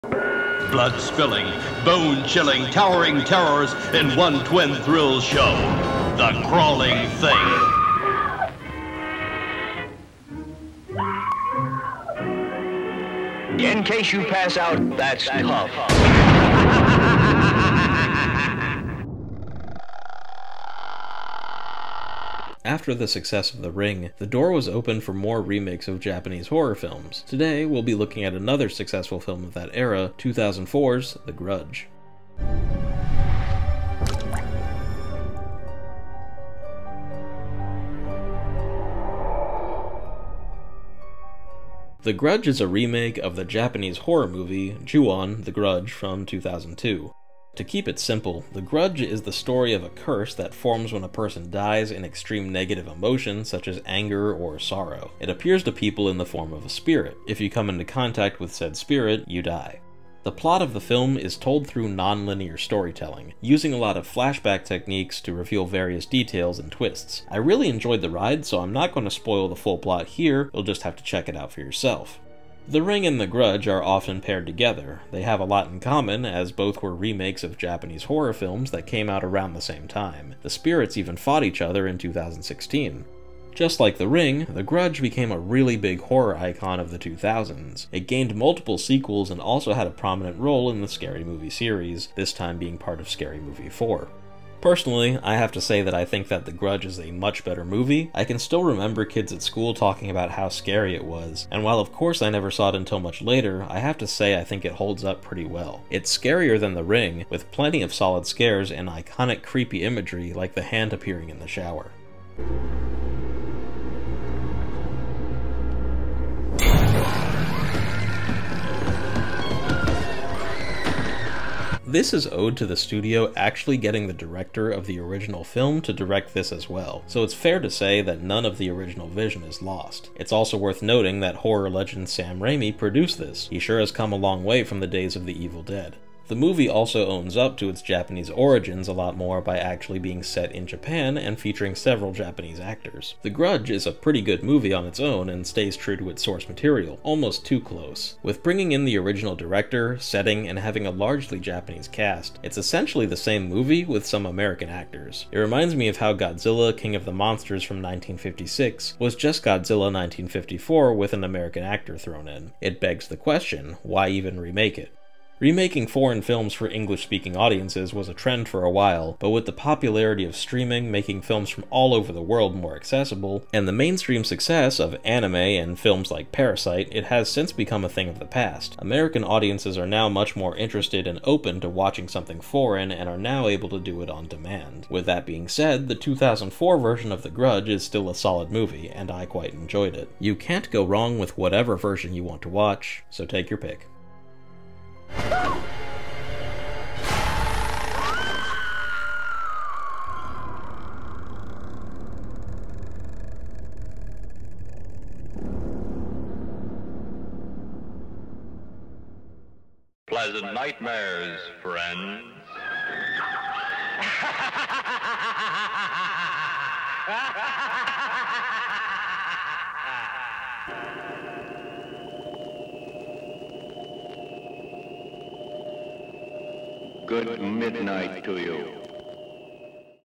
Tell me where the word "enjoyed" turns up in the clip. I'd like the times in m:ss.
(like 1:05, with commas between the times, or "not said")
1:07, 3:09.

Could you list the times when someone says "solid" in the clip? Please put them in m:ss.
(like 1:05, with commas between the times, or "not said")
1:47, 3:08.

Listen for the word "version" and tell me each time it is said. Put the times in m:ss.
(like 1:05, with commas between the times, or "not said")
3:06, 3:11.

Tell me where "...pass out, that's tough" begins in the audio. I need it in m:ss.
0:14.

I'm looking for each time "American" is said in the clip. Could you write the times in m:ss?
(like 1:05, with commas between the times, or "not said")
2:34, 2:41, 2:58.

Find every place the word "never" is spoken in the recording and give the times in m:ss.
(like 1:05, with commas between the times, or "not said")
1:42.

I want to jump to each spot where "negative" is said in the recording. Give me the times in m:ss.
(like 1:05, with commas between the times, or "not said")
0:52.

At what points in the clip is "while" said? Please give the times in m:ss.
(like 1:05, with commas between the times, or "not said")
1:41, 2:48.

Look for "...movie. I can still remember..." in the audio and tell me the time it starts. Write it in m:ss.
1:37.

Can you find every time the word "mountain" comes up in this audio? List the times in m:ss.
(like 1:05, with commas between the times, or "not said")
not said.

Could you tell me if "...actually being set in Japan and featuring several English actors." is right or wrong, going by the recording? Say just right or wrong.
wrong.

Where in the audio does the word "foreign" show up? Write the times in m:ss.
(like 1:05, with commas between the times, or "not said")
2:45, 3:02.